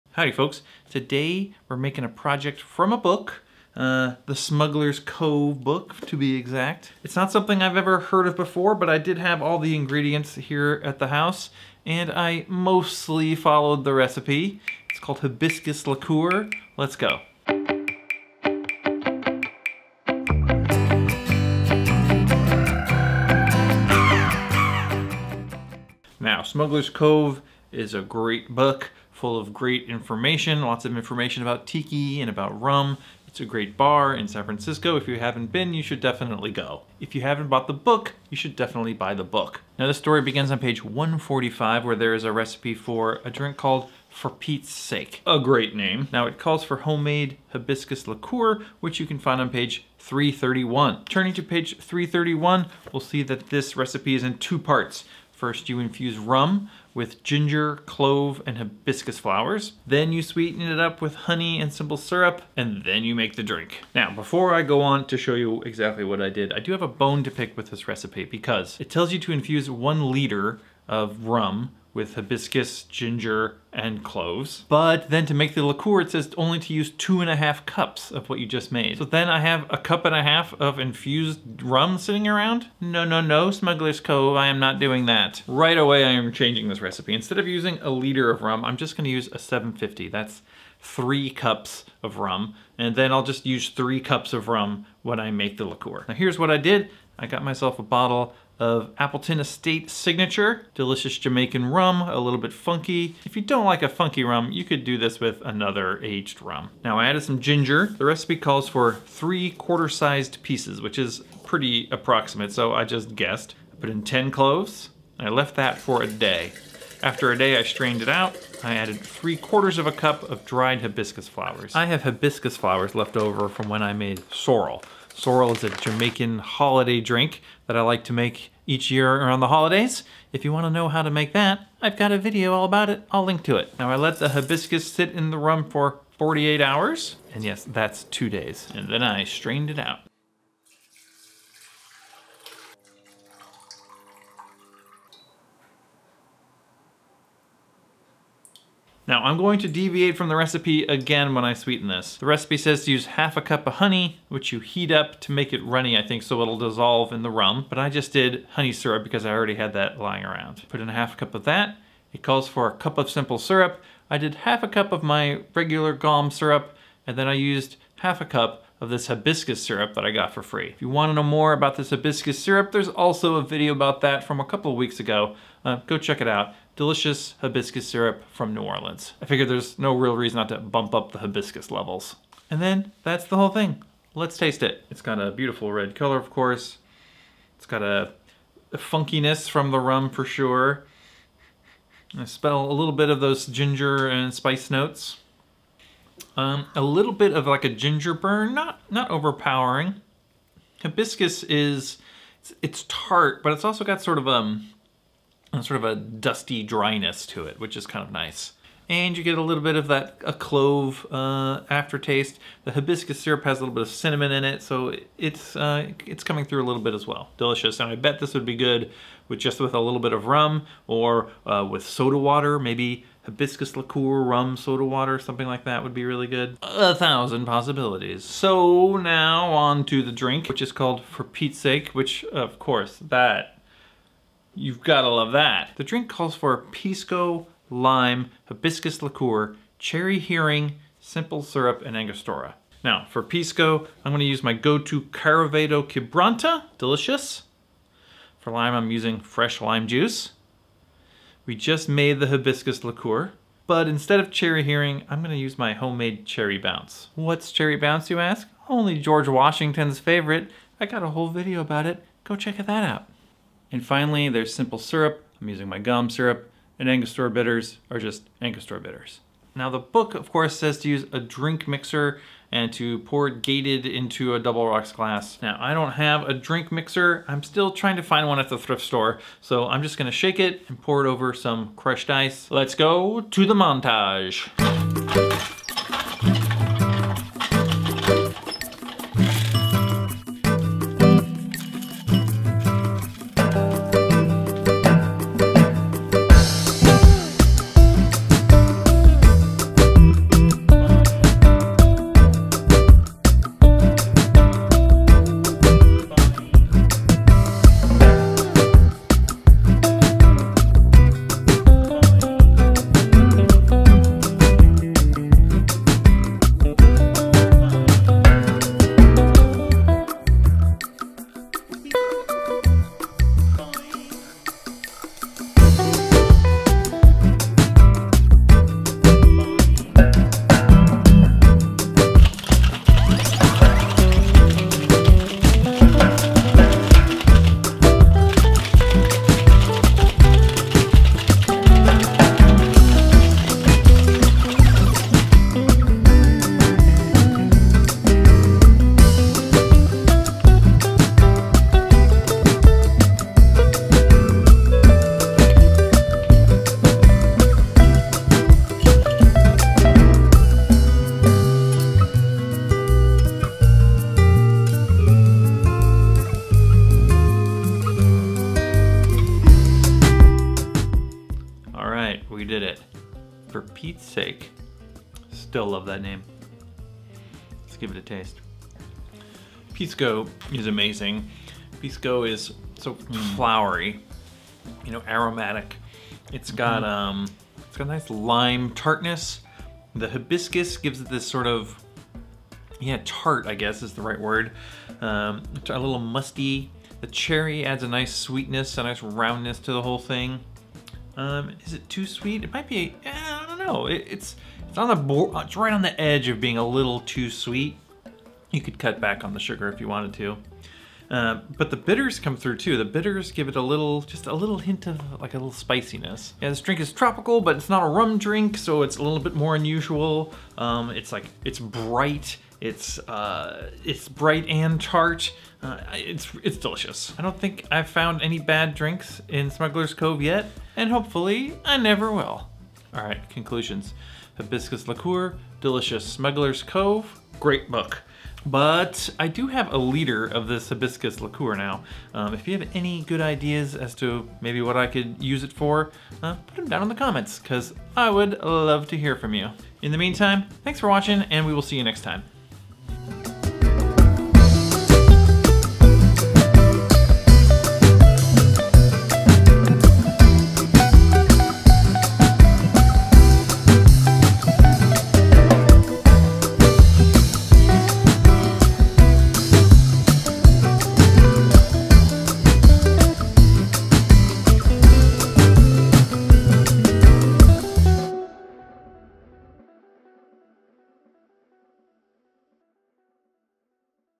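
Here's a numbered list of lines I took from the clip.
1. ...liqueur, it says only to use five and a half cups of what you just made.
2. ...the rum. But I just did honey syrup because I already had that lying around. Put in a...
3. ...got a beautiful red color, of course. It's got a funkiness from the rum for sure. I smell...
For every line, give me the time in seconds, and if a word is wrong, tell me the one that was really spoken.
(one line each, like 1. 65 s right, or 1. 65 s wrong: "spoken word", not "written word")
1. 75 s wrong: "two", not "five"
2. 157 s right
3. 185 s right.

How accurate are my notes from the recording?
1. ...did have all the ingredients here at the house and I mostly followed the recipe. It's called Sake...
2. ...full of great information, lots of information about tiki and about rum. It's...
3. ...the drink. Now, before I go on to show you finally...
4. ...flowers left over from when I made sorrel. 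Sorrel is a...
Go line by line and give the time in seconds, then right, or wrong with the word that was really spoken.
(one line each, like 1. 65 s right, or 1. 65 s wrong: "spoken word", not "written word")
1. 8 s wrong: "Hibiscus", not "Sake"
2. 29 s right
3. 63 s wrong: "exactly", not "finally"
4. 122 s right.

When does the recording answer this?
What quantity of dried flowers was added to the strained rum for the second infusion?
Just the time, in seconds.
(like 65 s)
118 s.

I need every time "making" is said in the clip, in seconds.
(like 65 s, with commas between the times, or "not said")
1 s.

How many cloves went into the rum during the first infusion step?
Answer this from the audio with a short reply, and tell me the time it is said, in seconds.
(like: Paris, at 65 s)
10, at 114 s.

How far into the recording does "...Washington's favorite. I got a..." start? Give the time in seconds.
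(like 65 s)
259 s.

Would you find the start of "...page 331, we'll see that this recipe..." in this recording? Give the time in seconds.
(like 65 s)
51 s.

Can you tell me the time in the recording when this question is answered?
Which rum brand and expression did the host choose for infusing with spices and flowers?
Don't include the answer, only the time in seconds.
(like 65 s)
98 s.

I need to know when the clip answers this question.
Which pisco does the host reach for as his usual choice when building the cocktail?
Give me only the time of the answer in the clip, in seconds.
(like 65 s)
245 s.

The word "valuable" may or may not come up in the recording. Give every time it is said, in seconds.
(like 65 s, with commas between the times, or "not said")
not said.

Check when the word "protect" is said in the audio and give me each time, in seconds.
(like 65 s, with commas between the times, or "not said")
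not said.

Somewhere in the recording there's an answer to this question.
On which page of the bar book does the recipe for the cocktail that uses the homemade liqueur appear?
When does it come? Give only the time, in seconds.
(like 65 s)
40 s.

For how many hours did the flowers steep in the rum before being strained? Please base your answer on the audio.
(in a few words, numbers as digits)
48.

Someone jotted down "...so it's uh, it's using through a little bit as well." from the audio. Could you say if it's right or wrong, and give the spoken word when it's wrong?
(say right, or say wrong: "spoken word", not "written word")
wrong: "coming", not "using".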